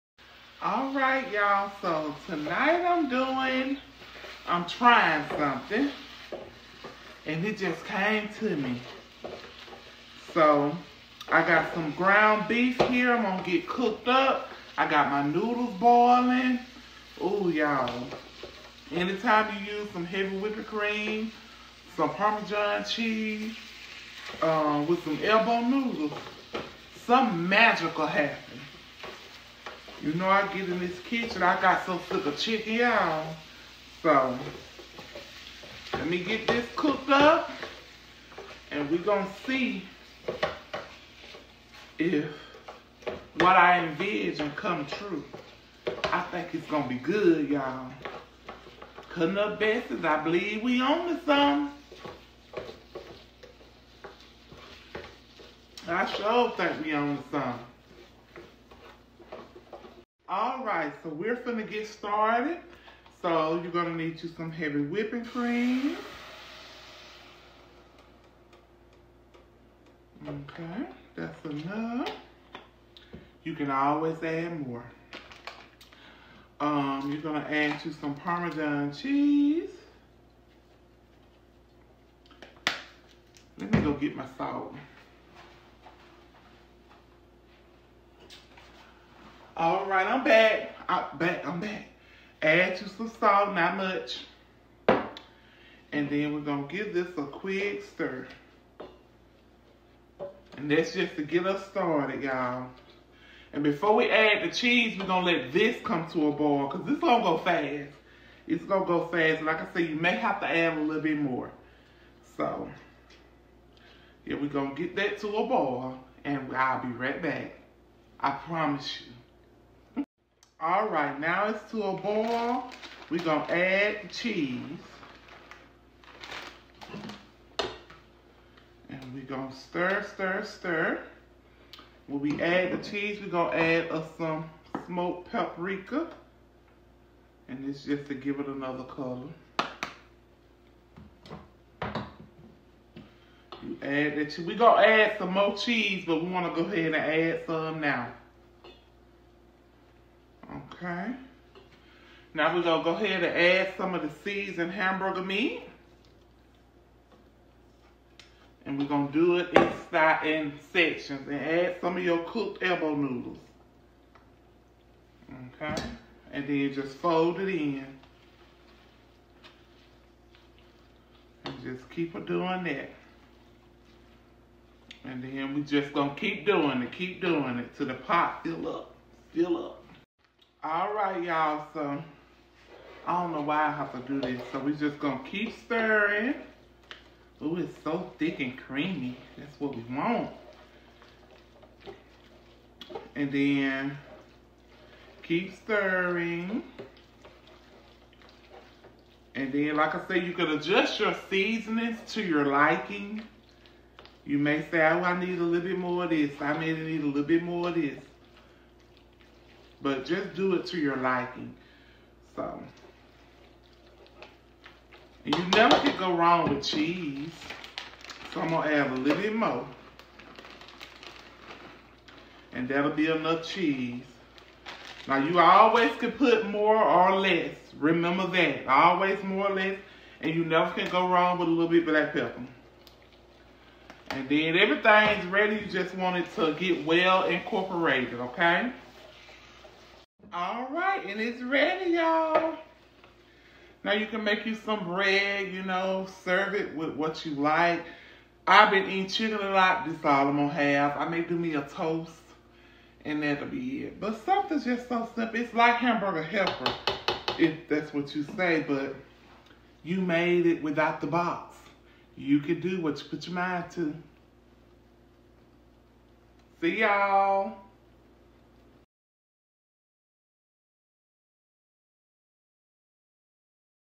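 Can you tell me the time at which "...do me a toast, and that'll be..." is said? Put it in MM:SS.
04:11.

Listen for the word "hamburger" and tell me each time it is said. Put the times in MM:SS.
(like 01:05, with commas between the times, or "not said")
02:34, 04:15.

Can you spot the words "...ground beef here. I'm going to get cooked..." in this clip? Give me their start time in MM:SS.
00:11.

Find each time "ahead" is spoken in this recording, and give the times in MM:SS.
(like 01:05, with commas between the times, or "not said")
02:26, 02:32.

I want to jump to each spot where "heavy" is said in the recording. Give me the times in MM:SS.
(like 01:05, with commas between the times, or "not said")
00:20, 01:04.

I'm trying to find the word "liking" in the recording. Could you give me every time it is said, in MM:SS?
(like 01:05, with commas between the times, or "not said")
03:22, 03:30.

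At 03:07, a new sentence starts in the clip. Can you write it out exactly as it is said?
Ooh, it's so thick and creamy.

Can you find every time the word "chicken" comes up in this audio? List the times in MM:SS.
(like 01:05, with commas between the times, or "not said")
00:32, 04:09.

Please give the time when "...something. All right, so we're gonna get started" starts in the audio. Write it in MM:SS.
00:57.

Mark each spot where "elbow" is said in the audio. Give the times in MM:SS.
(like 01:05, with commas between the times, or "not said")
00:25, 02:42.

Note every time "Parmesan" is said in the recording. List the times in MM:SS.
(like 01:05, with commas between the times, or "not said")
00:22, 01:18.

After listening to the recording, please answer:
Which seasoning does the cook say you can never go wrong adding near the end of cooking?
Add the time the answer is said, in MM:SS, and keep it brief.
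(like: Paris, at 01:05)
black pepper, at 03:51.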